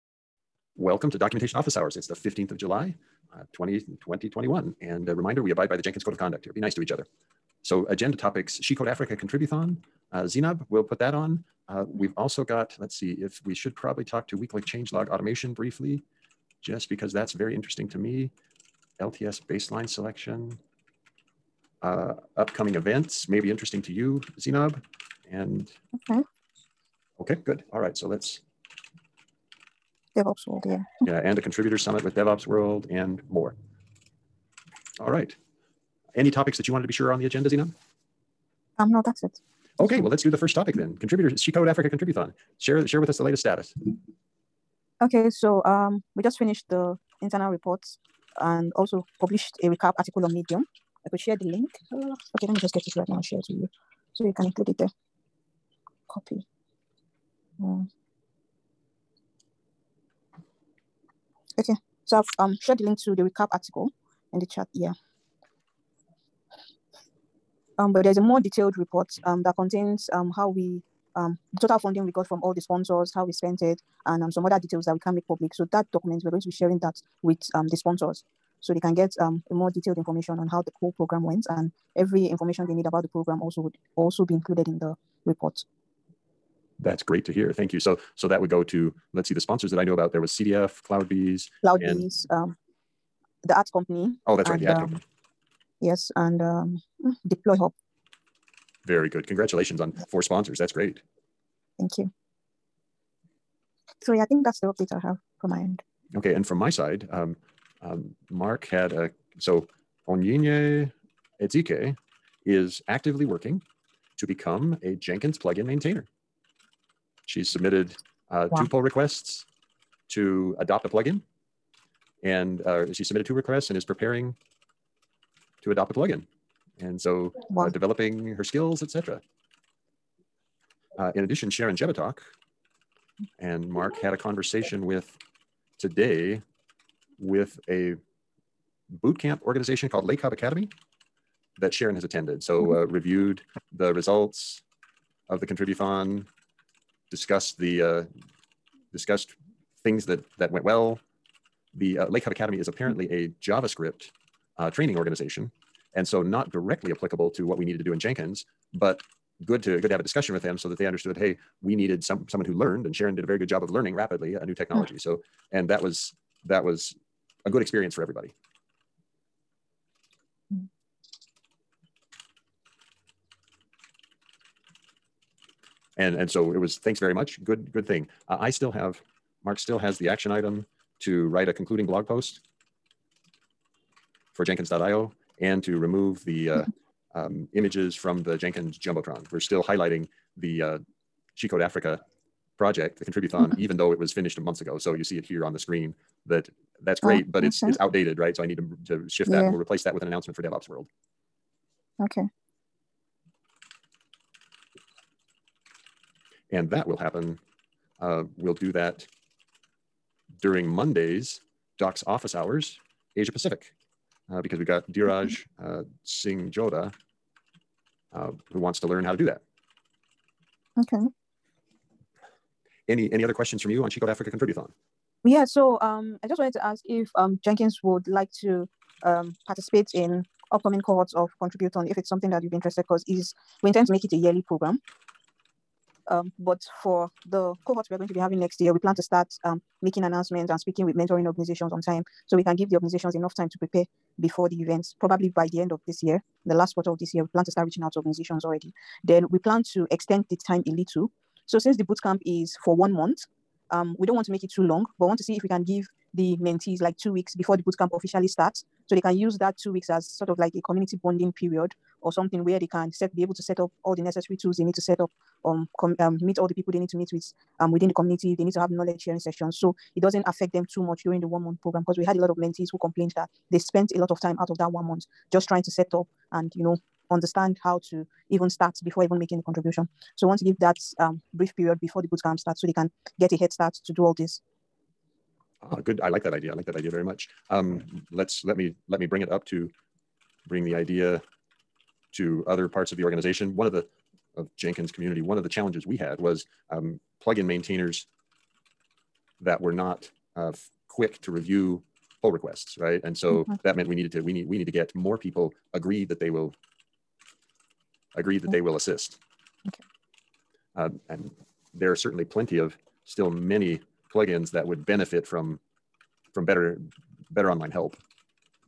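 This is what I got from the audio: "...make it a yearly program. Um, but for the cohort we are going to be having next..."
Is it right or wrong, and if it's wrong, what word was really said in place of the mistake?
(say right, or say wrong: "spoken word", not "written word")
right.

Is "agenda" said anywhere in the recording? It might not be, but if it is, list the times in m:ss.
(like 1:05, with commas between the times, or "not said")
0:07, 0:37.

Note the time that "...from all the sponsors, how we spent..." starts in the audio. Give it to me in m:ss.
1:12.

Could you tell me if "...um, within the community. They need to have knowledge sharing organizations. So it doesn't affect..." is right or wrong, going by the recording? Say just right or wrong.
wrong.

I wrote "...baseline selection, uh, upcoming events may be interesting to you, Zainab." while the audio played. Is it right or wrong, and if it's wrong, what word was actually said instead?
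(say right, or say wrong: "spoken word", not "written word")
right.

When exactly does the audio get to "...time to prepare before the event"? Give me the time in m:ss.
4:03.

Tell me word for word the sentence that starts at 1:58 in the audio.
two pull requests to adopt a plugin.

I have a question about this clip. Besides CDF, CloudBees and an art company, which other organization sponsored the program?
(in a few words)
DeployHub.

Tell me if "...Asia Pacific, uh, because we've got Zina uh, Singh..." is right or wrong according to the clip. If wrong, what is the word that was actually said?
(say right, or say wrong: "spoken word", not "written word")
wrong: "Dheeraj", not "Zina".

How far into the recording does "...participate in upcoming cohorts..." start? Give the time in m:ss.
3:49.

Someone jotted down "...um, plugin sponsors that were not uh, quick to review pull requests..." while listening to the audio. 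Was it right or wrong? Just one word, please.
wrong.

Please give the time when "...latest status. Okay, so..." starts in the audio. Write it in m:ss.
0:43.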